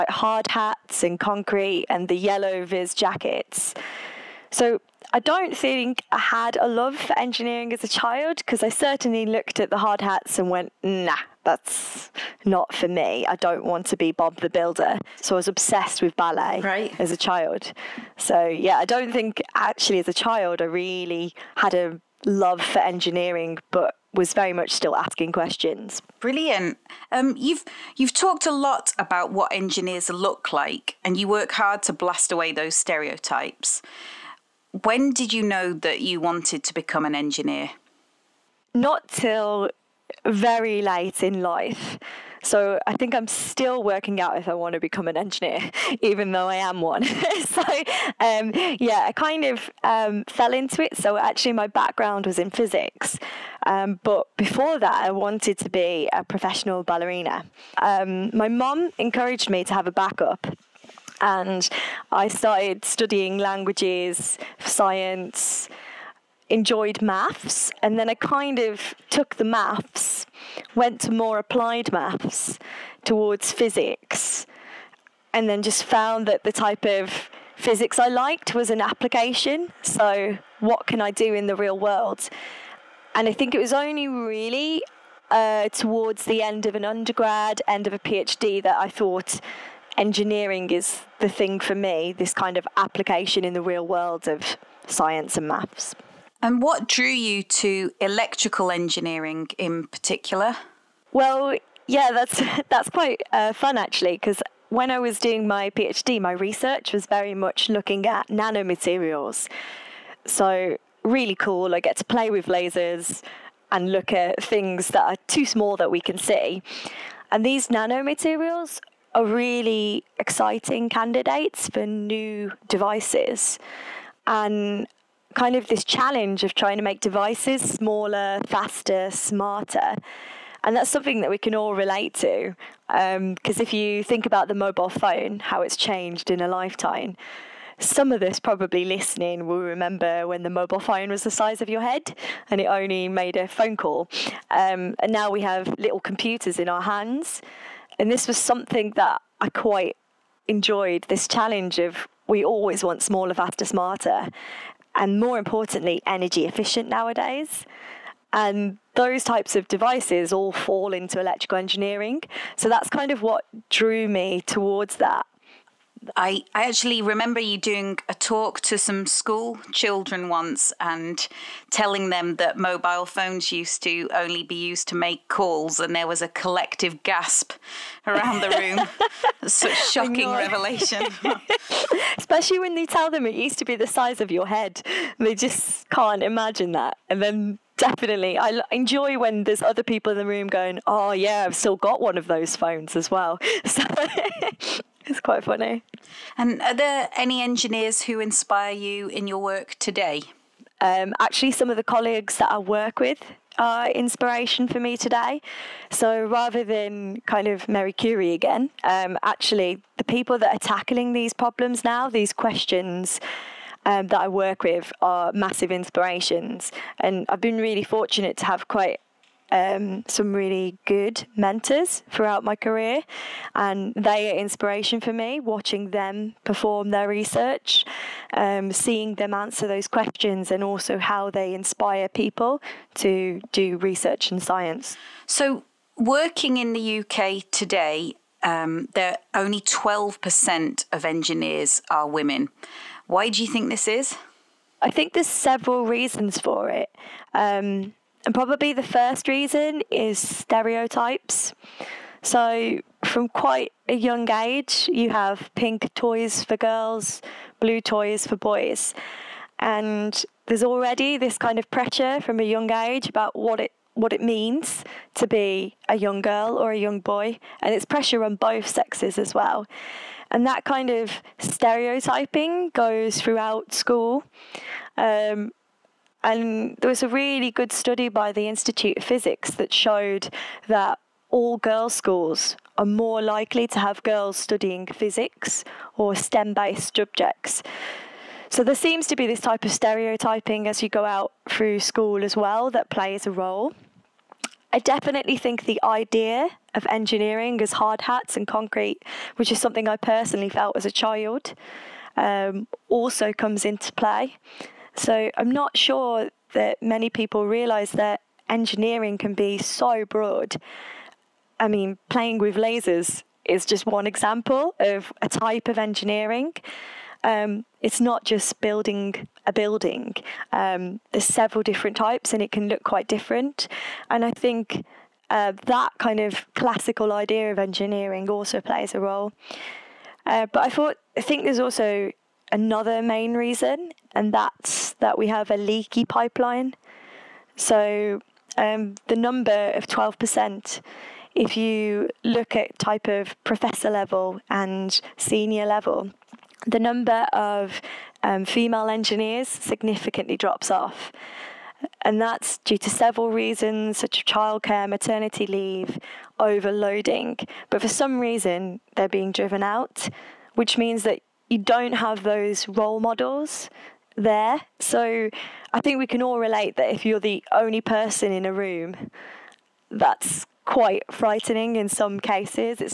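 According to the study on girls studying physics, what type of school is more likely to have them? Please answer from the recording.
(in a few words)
All girls' schools.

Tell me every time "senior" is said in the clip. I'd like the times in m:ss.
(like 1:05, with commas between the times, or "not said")
5:45.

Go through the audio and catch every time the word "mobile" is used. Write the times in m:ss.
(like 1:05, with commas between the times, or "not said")
2:14, 2:20, 2:52.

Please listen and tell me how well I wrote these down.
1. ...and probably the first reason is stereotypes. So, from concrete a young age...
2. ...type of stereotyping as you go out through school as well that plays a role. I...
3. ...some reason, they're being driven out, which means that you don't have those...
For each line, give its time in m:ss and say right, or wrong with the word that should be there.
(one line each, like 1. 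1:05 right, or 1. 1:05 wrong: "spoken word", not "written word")
1. 4:08 wrong: "quite", not "concrete"
2. 4:49 right
3. 5:57 right.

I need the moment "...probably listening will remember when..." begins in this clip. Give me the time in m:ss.
2:18.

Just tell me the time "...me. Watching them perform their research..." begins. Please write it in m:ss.
3:45.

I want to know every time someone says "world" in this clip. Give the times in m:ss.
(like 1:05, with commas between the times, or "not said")
1:21, 1:33.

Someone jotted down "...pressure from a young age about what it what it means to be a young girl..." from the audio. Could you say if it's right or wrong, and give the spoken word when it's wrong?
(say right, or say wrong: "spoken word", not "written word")
right.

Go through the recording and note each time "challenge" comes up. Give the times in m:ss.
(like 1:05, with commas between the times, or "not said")
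2:05, 2:31.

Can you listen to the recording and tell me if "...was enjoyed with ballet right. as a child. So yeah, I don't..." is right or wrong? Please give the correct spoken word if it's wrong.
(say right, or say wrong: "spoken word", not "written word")
wrong: "obsessed", not "enjoyed".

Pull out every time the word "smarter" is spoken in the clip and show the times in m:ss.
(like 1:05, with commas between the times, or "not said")
2:09, 2:33.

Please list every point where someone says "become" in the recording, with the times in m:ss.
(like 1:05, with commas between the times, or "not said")
0:36, 0:44.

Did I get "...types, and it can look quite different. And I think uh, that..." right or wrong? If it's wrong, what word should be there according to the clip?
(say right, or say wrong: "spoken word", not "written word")
right.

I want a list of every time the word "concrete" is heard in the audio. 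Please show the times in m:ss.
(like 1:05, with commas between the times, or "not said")
0:01, 4:58.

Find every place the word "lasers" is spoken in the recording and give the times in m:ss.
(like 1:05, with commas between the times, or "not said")
1:52, 5:12.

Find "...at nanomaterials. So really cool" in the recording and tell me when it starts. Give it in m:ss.
1:48.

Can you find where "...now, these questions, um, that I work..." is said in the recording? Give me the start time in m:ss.
3:31.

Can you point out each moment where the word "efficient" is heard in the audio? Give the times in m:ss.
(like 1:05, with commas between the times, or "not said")
2:36.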